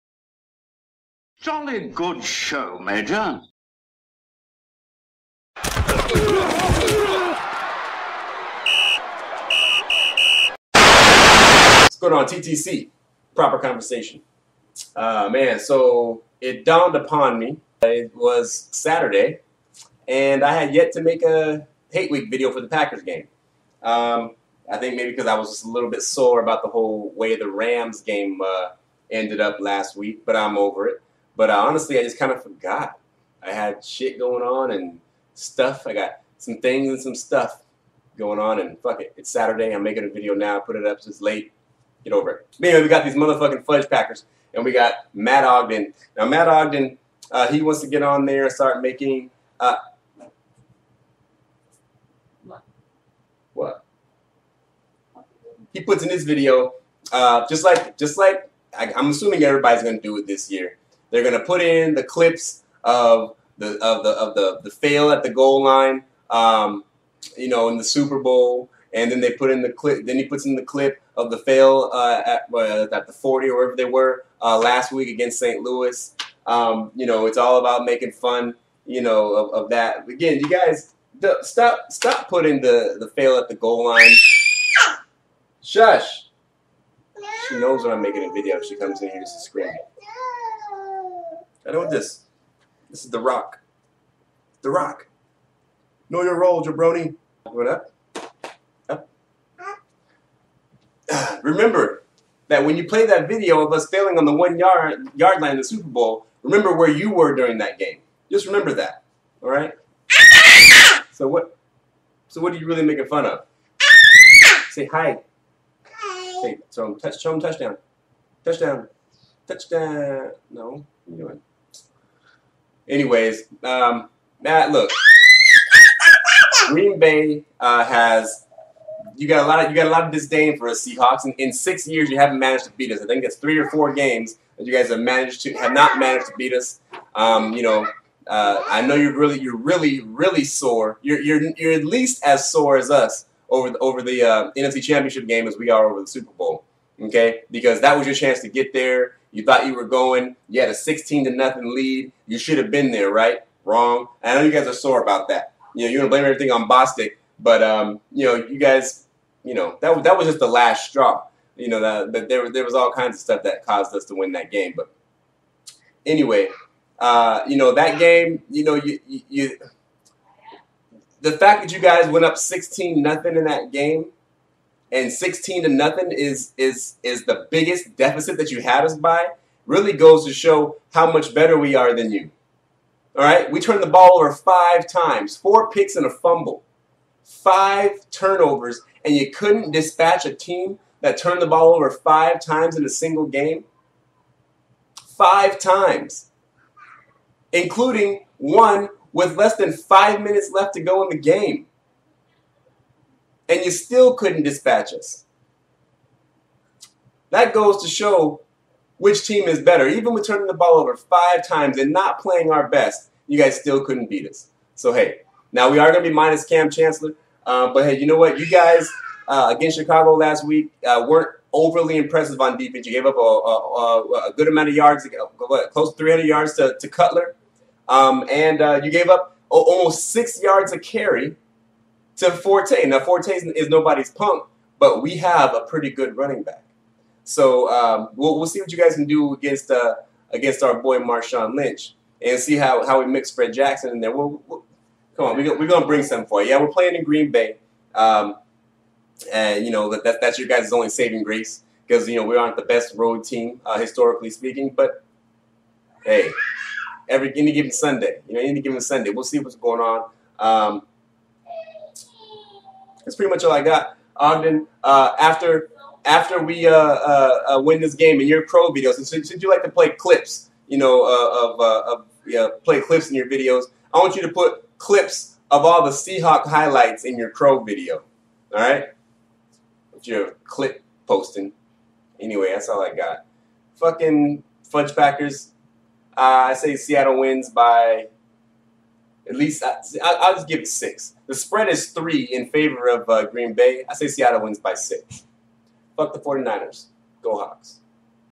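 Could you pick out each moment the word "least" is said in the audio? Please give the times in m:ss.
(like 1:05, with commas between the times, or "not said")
2:21, 4:49.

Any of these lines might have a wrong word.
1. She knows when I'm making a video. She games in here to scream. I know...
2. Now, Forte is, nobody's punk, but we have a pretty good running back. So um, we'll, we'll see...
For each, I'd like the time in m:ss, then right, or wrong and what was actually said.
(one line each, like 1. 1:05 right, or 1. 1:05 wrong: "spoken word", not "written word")
1. 1:27 wrong: "comes", not "games"
2. 3:52 right.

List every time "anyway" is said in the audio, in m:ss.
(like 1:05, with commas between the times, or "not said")
0:42, 2:02, 2:46, 4:42.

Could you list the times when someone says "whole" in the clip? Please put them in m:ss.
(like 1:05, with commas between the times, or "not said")
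0:26.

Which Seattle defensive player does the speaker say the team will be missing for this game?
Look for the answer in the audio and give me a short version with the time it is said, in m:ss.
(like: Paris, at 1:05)
Kam Chancellor, at 3:36.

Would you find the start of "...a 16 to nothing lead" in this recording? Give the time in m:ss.
2:30.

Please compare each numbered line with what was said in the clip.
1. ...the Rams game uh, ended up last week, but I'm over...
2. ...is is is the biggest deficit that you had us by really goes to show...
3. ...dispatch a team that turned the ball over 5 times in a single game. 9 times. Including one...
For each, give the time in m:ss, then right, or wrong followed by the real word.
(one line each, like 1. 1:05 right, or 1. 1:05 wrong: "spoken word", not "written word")
1. 0:27 right
2. 2:56 right
3. 3:09 wrong: "5", not "9".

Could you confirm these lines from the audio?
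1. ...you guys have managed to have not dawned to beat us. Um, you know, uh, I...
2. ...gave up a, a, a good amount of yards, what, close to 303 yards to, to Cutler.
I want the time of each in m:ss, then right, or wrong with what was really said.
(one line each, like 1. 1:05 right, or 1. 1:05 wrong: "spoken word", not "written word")
1. 2:14 wrong: "managed", not "dawned"
2. 3:42 wrong: "300", not "303".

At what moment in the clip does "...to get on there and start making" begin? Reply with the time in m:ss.
0:47.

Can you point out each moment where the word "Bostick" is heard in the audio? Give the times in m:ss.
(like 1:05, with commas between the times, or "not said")
2:36.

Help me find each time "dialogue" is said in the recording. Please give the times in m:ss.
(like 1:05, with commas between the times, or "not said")
not said.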